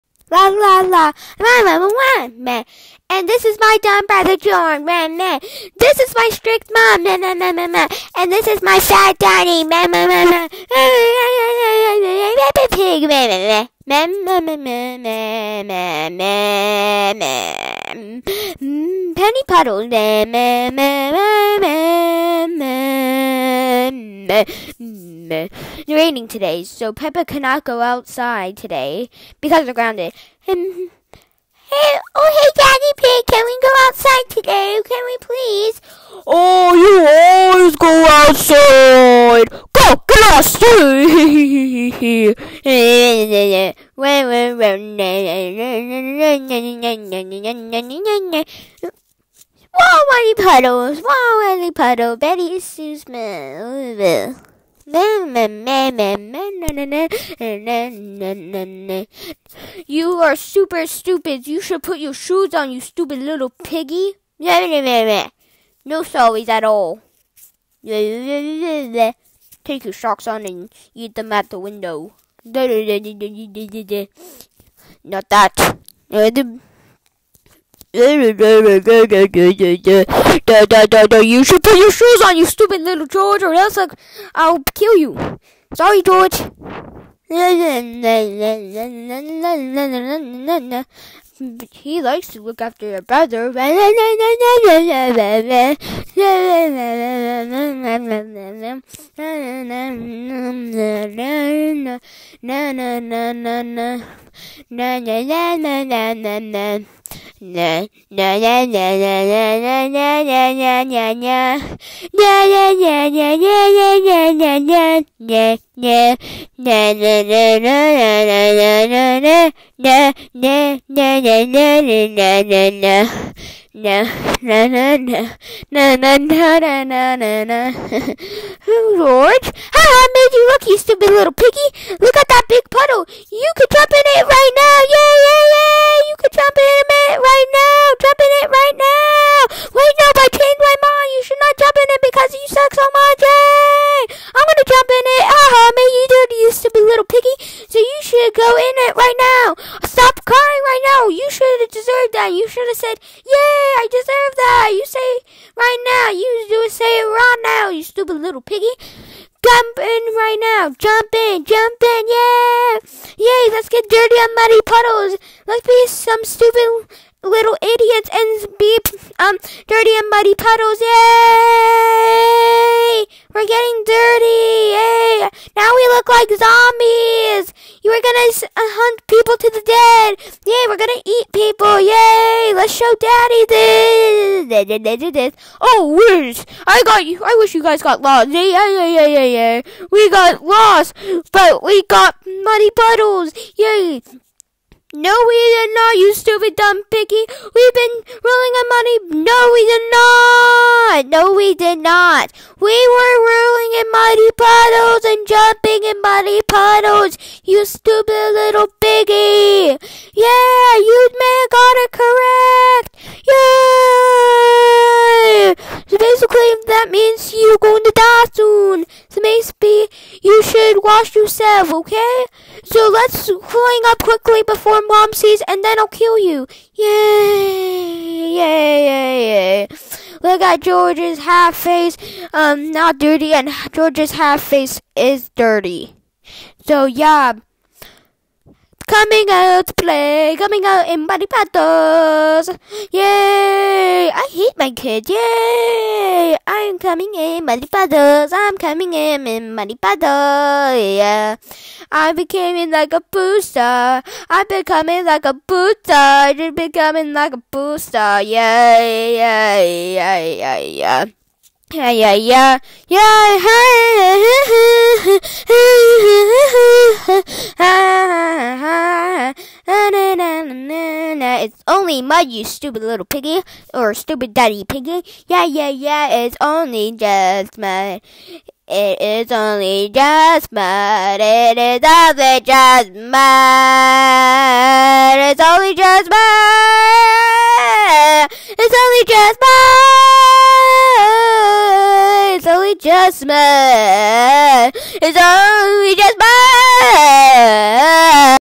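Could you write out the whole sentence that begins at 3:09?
We got lost, but we got muddy puddles.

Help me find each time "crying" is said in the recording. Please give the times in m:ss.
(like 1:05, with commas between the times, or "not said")
2:30.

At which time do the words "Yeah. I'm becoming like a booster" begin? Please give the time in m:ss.
4:10.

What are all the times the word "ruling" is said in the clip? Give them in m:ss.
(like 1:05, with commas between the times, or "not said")
3:18, 3:23.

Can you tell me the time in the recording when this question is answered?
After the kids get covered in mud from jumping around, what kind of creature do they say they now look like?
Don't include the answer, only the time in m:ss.
2:56.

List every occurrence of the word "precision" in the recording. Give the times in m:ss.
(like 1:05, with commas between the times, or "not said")
not said.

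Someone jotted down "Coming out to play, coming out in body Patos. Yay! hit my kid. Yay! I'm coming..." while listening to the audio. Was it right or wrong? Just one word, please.
right.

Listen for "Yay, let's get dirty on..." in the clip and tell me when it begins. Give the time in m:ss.
2:43.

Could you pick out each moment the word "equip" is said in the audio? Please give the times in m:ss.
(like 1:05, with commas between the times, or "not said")
not said.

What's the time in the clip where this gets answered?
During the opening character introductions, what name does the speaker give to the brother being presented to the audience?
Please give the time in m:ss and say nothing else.
0:04.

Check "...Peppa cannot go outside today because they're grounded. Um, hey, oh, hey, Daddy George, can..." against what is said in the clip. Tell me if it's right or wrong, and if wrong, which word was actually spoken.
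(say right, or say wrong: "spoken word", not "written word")
wrong: "Pig", not "George".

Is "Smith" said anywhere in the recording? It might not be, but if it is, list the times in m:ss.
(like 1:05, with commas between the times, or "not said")
0:52.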